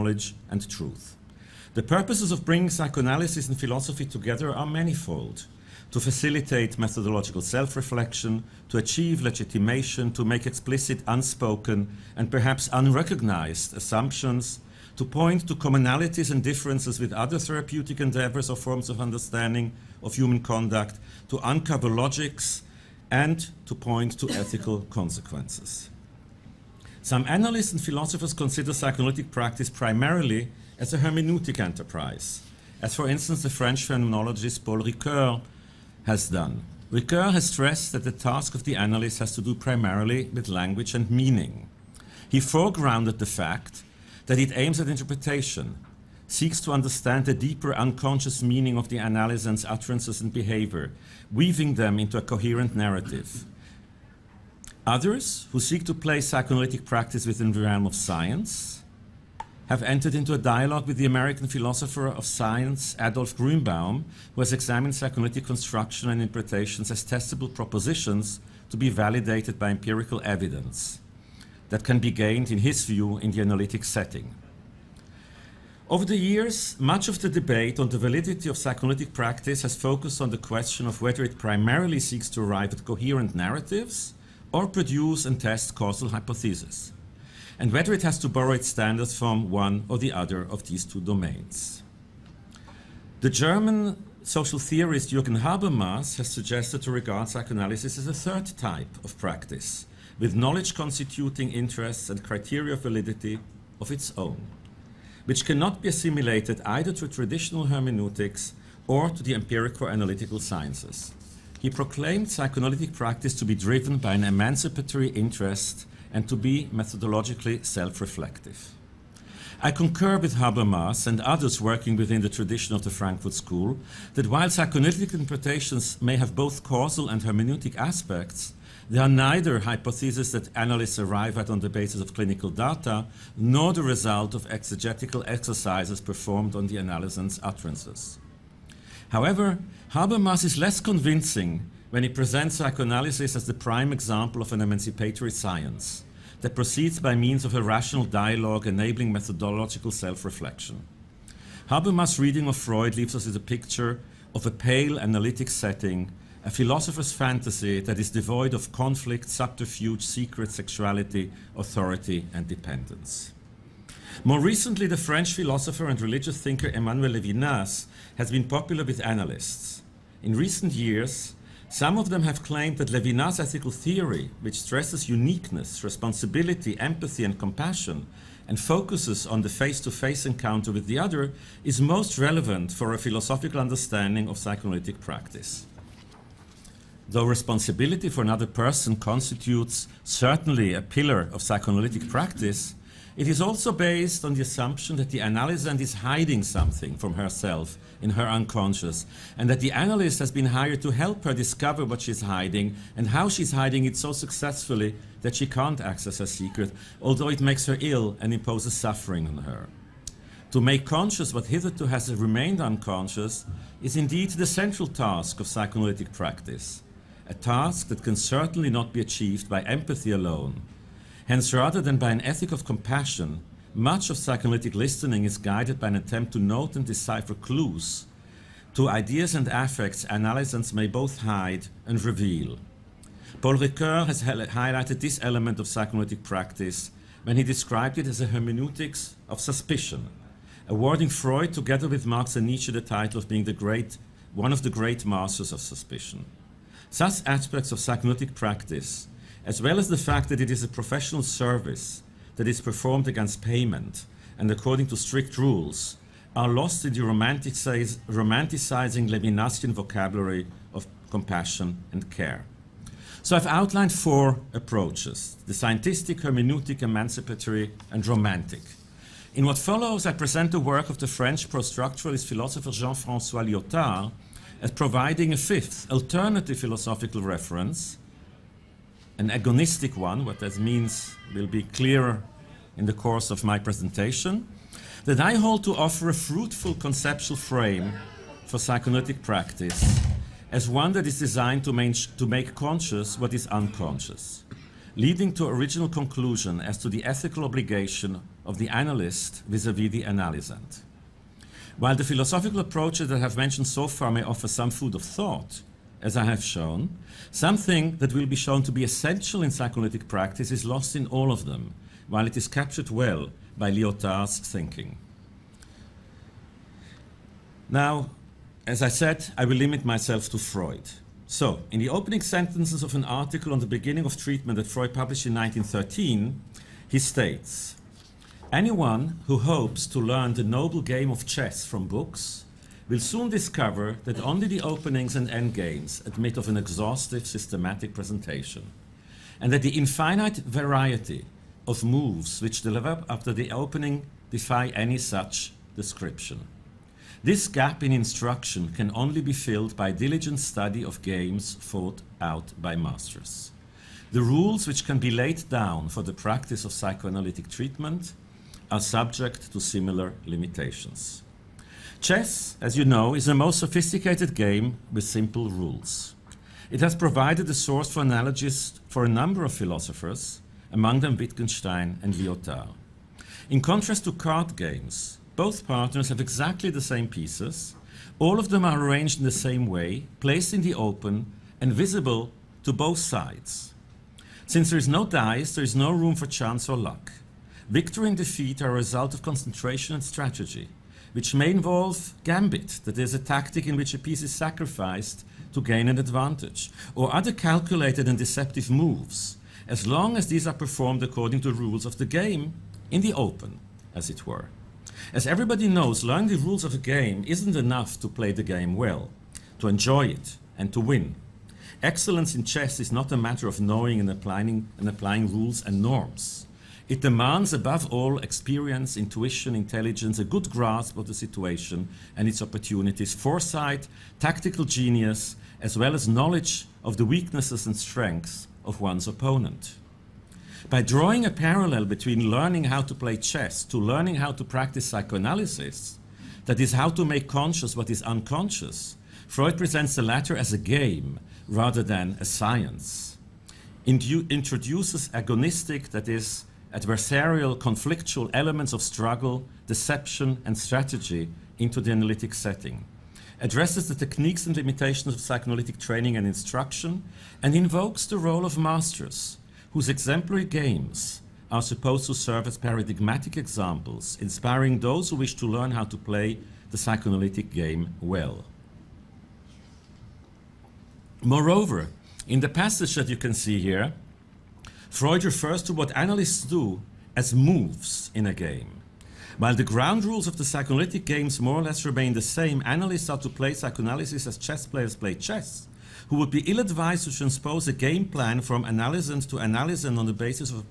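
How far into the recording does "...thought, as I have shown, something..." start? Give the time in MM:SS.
05:05.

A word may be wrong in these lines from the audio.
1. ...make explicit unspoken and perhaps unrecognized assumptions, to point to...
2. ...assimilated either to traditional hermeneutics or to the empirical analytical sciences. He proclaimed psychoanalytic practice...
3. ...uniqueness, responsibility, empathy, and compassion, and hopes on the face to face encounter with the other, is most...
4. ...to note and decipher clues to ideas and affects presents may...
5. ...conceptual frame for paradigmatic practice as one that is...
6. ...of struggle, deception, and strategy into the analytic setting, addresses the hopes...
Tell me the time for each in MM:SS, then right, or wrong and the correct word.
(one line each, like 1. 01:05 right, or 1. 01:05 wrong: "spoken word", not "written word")
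1. 00:10 right
2. 01:45 right
3. 02:55 wrong: "focuses", not "hopes"
4. 03:46 wrong: "analysts", not "presents"
5. 04:46 wrong: "psychoanalytic", not "paradigmatic"
6. 07:28 wrong: "techniques", not "hopes".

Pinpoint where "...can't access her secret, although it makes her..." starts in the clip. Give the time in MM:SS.
03:25.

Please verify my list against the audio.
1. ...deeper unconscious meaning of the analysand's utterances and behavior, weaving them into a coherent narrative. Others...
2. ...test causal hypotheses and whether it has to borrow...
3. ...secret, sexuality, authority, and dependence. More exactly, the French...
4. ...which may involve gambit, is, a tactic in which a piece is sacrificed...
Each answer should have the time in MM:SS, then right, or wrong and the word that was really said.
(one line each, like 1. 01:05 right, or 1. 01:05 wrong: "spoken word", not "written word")
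1. 00:47 right
2. 01:25 right
3. 02:40 wrong: "recently", not "exactly"
4. 06:31 right.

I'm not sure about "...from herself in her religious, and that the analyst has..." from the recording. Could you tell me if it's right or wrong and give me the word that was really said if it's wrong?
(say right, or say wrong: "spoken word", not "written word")
wrong: "unconscious", not "religious".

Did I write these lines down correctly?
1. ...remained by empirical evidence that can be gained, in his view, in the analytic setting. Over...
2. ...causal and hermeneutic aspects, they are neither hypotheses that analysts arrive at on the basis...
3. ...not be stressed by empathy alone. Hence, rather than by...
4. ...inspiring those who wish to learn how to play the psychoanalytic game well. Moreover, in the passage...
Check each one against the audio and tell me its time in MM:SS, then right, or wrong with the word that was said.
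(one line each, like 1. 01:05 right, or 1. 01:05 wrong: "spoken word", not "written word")
1. 01:08 wrong: "validated", not "remained"
2. 02:06 right
3. 03:38 wrong: "achieved", not "stressed"
4. 07:44 right.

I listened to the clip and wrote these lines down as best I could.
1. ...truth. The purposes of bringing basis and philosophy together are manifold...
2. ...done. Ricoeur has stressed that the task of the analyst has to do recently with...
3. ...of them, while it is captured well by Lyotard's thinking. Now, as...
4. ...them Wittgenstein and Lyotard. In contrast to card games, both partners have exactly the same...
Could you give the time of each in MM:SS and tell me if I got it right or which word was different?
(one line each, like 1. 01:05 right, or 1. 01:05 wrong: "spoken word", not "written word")
1. 00:00 wrong: "psychoanalysis", not "basis"
2. 00:36 wrong: "primarily", not "recently"
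3. 05:11 right
4. 06:10 right.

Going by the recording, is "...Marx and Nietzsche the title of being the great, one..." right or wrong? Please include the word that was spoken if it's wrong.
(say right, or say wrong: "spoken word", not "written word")
right.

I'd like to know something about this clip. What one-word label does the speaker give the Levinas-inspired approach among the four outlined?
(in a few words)
romantic.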